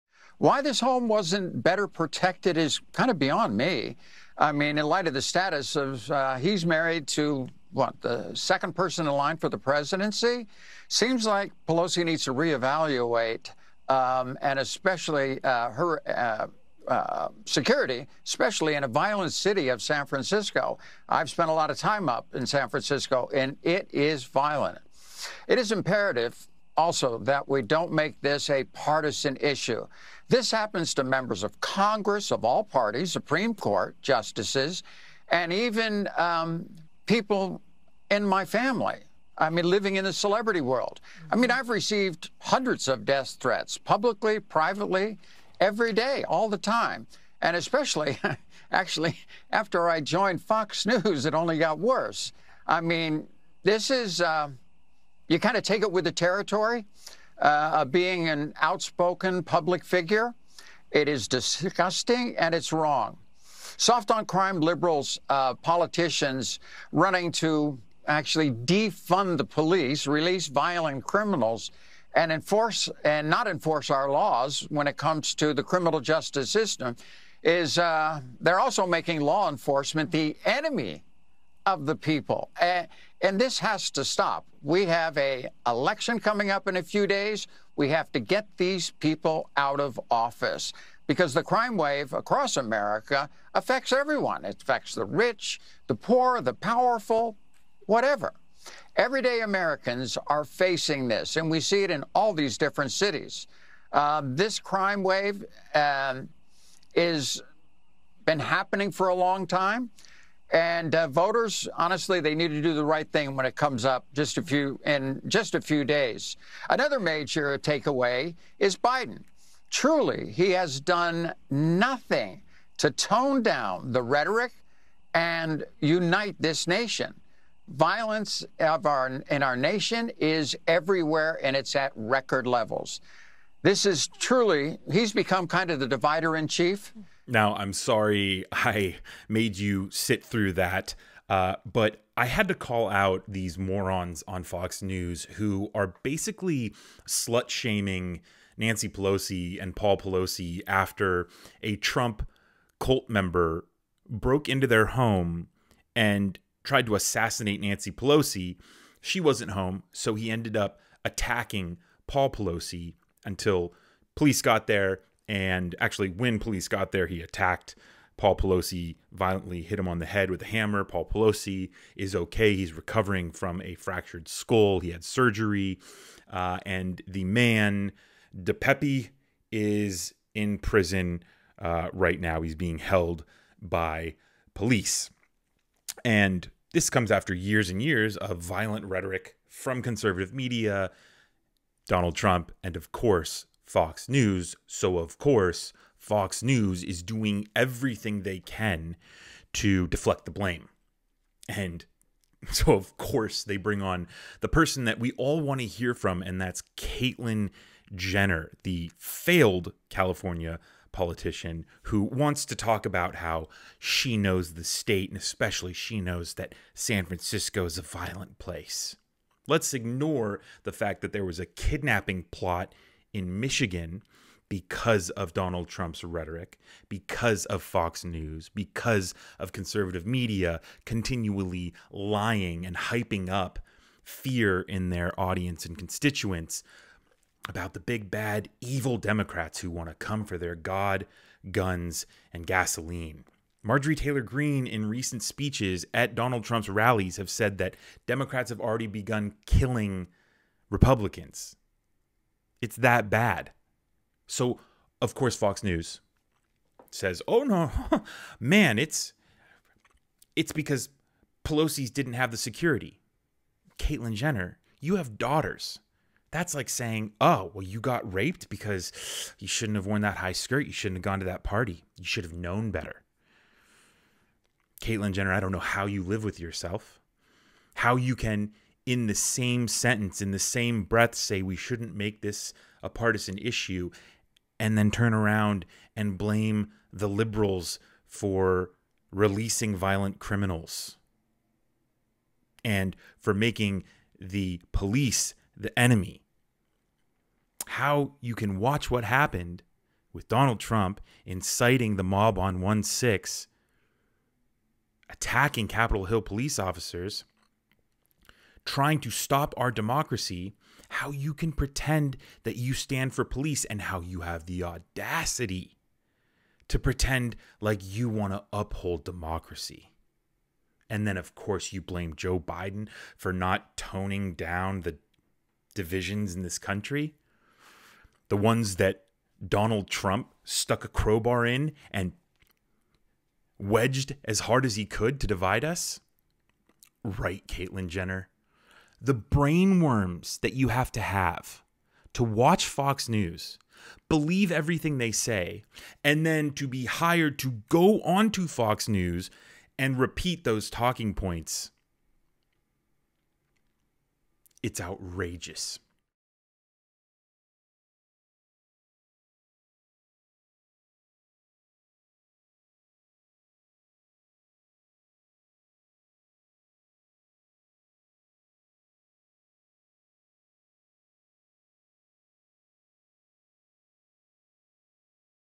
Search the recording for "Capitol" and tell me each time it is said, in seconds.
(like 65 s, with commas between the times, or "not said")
305 s.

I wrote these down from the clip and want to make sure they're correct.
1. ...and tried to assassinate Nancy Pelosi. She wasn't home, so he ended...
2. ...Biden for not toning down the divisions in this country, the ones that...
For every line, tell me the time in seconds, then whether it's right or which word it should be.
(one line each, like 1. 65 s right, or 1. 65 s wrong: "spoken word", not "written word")
1. 155 s right
2. 322 s right.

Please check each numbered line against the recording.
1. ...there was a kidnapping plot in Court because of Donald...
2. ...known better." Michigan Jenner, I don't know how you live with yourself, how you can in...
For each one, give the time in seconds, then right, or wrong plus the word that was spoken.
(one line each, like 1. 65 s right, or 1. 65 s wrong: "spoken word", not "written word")
1. 221 s wrong: "Michigan", not "Court"
2. 272 s wrong: "Caitlyn", not "Michigan".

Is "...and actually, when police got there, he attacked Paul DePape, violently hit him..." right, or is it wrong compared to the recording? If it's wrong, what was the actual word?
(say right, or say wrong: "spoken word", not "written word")
wrong: "Pelosi", not "DePape".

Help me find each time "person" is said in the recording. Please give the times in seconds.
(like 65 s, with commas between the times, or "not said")
8 s, 204 s.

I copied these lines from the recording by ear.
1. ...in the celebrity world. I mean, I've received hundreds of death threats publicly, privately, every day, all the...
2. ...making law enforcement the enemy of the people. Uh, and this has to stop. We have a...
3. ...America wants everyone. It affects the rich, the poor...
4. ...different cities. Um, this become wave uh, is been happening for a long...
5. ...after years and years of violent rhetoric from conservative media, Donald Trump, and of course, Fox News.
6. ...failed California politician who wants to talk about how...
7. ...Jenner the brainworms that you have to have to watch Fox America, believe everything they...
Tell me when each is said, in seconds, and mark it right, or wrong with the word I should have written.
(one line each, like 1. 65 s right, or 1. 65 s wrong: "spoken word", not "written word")
1. 39 s right
2. 78 s right
3. 92 s wrong: "affects", not "wants"
4. 102 s wrong: "crime", not "become"
5. 187 s right
6. 208 s right
7. 337 s wrong: "News", not "America".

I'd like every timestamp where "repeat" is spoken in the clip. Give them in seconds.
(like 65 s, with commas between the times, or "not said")
349 s.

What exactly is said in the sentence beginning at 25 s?
It is imperative also that we don't make this a partisan issue.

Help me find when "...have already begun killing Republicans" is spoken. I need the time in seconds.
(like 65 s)
248 s.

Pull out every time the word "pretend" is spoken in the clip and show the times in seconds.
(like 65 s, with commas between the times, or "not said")
311 s, 316 s.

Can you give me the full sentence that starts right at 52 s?
I mean, this is, uh, you kind of take it with the territory uh, being an outspoken public figure.